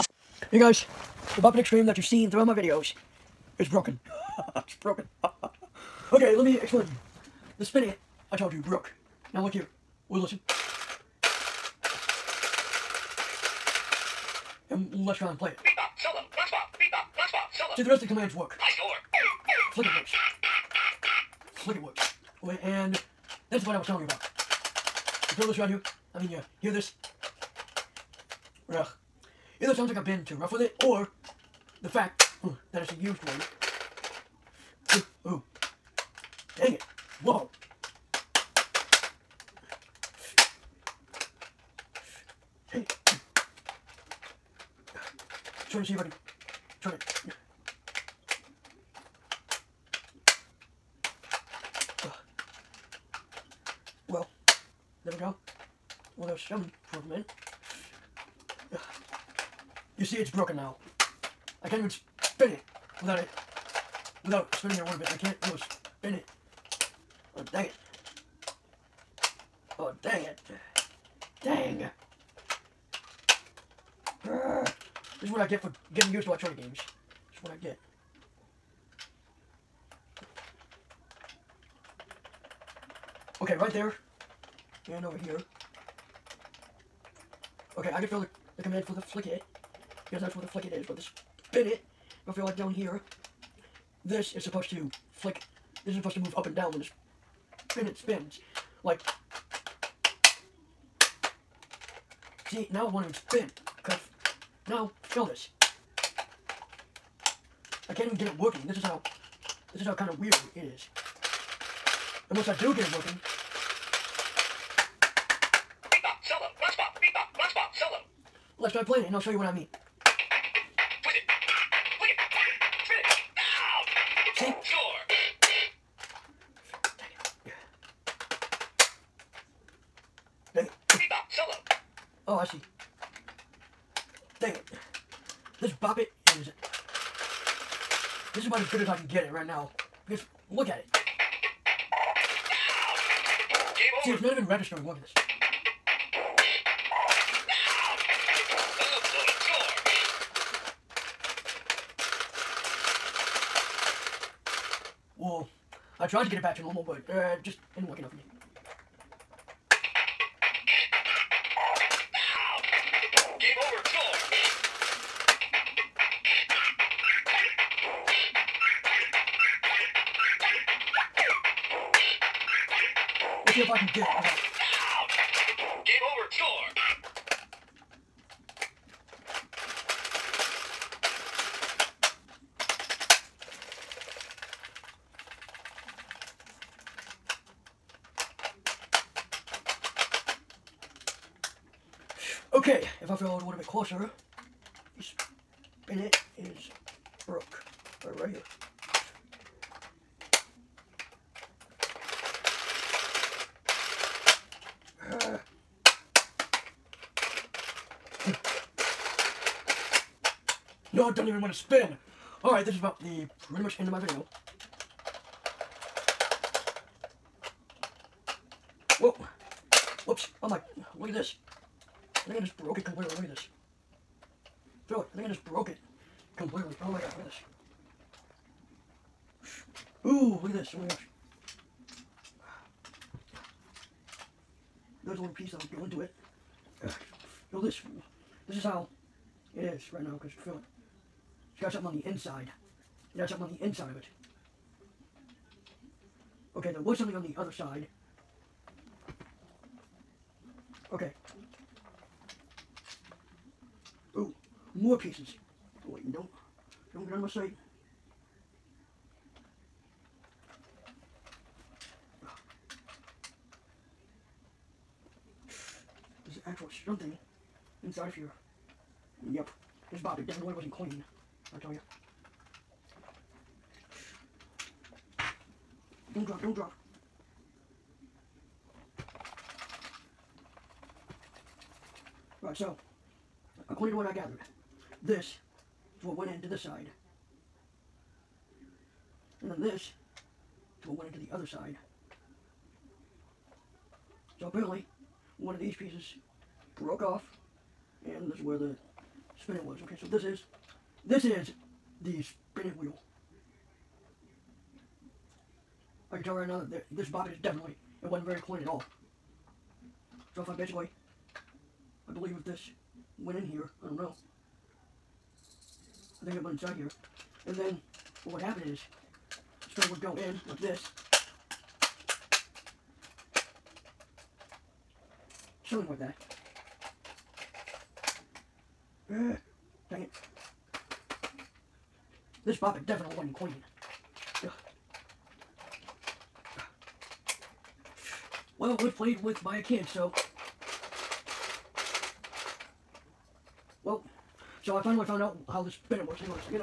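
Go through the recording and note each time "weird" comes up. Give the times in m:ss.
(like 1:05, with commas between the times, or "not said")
1:50.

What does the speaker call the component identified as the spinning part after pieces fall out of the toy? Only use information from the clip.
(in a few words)
the spinning wheel.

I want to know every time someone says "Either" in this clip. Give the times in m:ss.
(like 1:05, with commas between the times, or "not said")
0:29.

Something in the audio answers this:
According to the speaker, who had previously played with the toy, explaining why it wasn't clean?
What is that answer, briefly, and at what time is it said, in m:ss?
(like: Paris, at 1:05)
a kid, at 5:39.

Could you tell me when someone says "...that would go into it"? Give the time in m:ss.
3:55.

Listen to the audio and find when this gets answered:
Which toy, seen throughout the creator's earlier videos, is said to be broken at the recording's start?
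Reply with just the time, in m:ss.
0:01.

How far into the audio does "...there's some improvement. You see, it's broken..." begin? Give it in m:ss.
0:56.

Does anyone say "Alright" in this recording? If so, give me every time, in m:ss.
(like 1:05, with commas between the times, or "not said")
3:32, 4:42.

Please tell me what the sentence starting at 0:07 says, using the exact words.
The spinning, I told you, broke.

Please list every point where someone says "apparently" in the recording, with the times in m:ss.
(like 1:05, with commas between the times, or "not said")
4:54.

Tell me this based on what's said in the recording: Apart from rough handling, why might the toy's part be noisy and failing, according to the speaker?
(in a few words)
it's a used one.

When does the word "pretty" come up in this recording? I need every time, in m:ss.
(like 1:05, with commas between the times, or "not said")
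3:33.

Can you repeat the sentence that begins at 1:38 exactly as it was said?
Like, see, now I want to spin, because now, feel this.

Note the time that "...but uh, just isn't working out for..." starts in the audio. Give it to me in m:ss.
2:36.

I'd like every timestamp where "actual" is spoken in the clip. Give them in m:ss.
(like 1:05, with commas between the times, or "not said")
4:26.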